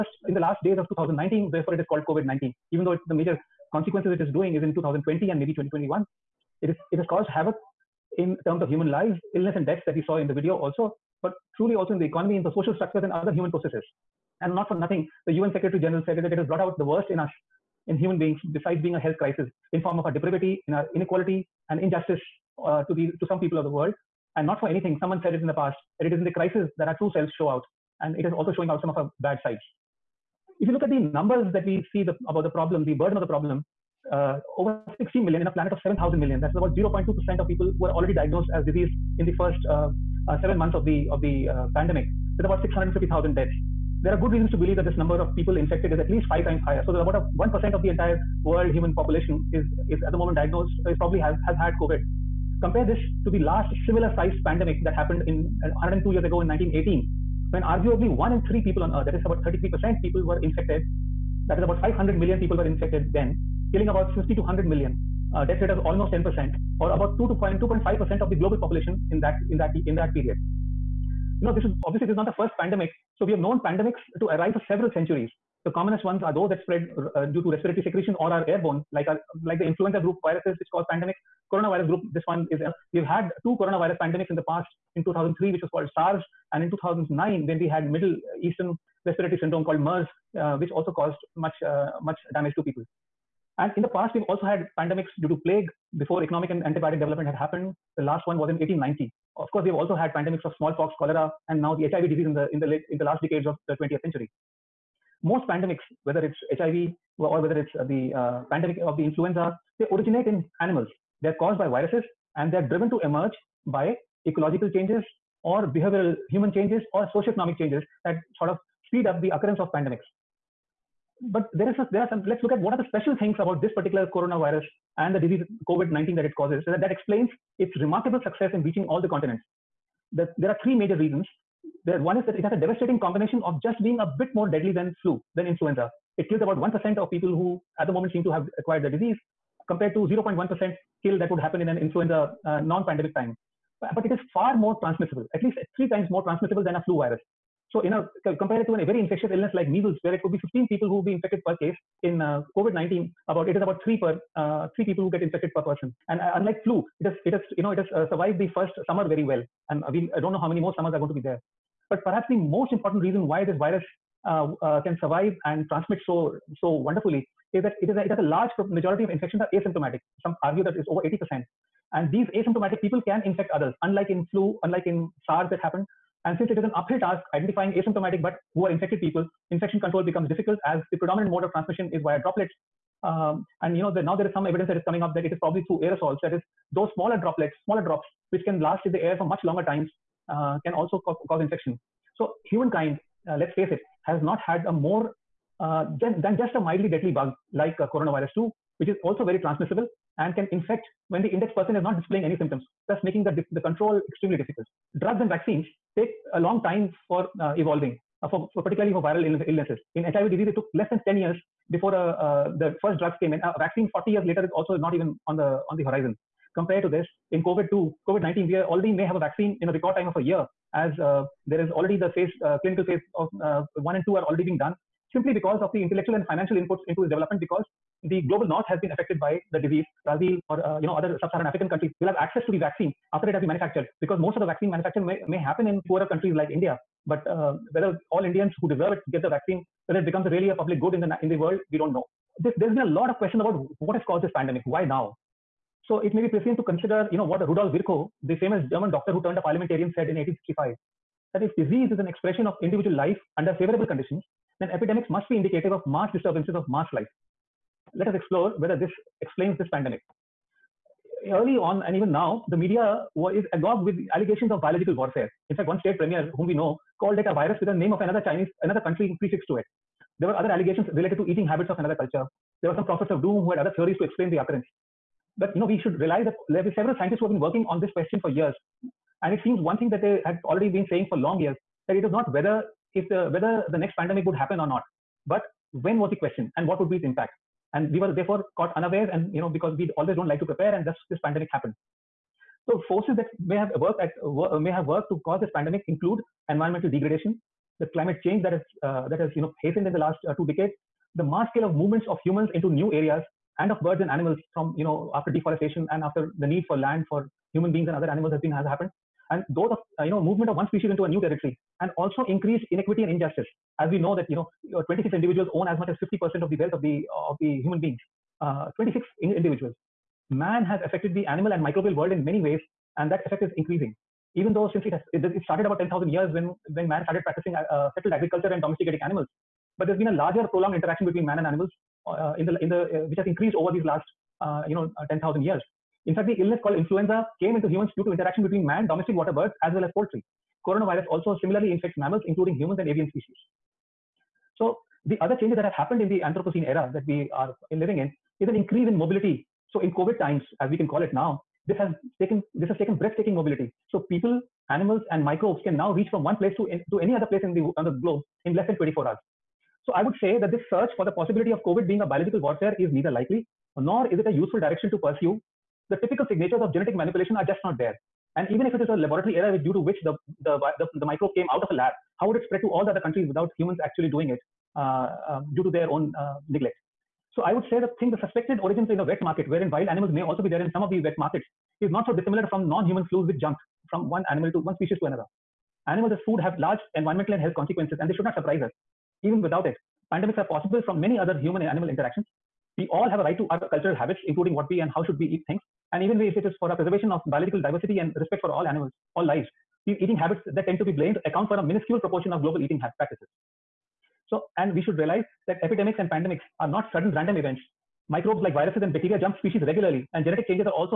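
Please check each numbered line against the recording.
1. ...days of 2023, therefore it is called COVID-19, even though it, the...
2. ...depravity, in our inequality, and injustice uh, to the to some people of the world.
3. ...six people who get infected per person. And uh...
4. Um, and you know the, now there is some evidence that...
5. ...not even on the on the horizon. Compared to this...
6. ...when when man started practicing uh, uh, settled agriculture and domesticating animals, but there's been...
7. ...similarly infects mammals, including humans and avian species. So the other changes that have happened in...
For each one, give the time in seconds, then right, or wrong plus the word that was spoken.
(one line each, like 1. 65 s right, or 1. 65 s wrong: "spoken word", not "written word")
1. 0 s wrong: "2019", not "2023"
2. 20 s right
3. 154 s wrong: "three", not "six"
4. 183 s right
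5. 214 s right
6. 326 s right
7. 341 s right.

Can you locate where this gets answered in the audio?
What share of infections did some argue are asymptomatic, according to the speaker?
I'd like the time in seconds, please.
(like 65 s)
170 s.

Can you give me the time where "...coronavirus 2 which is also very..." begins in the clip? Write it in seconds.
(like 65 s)
197 s.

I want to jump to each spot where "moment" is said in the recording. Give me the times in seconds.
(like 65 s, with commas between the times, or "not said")
50 s, 137 s.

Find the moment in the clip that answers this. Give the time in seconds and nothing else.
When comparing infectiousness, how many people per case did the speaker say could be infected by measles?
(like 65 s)
150 s.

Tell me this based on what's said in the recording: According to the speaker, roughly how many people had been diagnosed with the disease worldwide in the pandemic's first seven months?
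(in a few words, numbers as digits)
over 16 million.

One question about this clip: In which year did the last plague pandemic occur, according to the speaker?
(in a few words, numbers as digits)
1890.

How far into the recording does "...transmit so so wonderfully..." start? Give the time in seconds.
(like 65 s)
165 s.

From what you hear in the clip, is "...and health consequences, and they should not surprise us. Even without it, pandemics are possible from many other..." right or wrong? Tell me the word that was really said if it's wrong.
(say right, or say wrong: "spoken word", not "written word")
right.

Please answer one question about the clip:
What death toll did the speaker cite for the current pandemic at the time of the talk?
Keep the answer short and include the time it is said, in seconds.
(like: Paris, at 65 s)
650,000, at 42 s.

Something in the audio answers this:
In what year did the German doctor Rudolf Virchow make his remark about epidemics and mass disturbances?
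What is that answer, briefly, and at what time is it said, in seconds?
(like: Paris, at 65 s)
1865, at 250 s.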